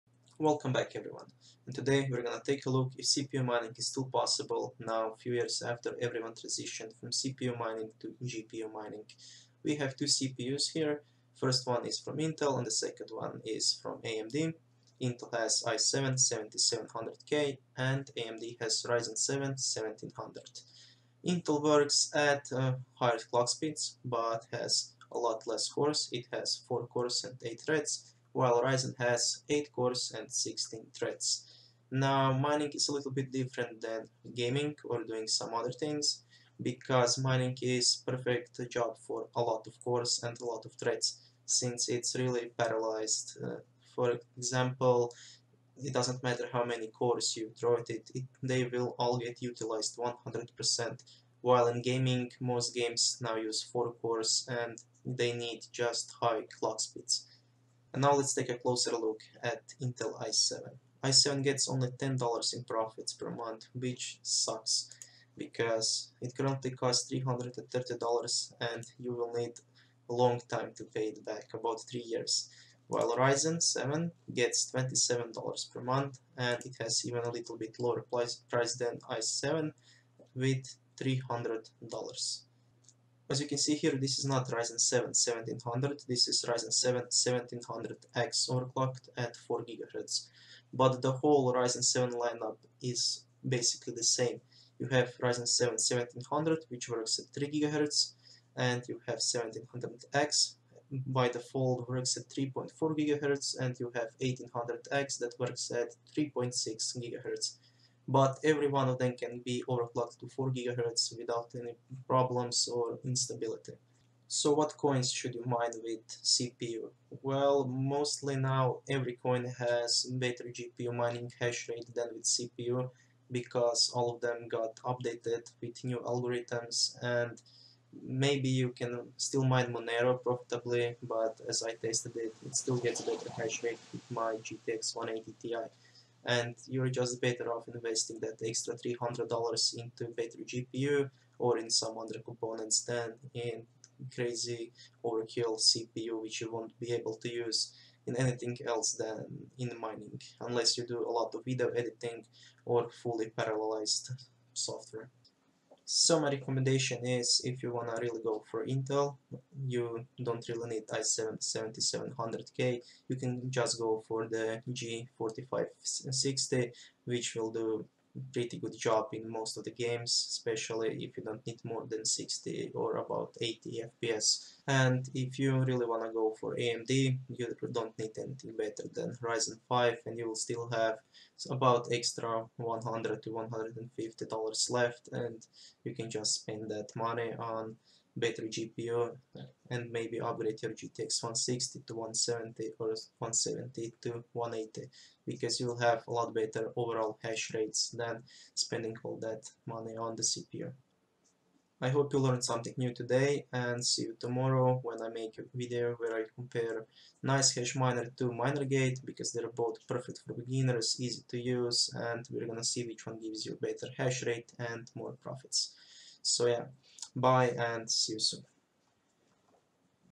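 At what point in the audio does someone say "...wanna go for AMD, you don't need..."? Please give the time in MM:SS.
02:55.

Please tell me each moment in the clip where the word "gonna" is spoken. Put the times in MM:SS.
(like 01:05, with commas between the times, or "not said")
00:02, 03:32.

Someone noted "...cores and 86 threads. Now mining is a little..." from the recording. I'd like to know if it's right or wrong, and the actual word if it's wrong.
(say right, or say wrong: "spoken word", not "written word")
wrong: "16", not "86".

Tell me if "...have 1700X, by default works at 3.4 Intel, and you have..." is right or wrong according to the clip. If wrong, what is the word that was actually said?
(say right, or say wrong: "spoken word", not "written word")
wrong: "GHz", not "Intel".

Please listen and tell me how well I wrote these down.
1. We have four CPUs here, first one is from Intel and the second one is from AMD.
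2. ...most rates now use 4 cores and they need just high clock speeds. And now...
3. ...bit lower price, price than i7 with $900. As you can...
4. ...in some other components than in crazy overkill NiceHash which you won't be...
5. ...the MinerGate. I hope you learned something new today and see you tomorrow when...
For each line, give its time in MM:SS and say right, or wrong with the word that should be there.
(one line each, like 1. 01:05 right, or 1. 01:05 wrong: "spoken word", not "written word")
1. 00:09 wrong: "two", not "four"
2. 00:52 wrong: "games", not "rates"
3. 01:17 wrong: "300", not "900"
4. 02:21 wrong: "CPU", not "NiceHash"
5. 03:20 wrong: "CPU", not "MinerGate".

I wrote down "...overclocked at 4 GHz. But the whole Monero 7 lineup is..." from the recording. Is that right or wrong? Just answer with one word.
wrong.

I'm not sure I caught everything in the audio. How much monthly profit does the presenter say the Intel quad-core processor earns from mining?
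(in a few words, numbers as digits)
$10.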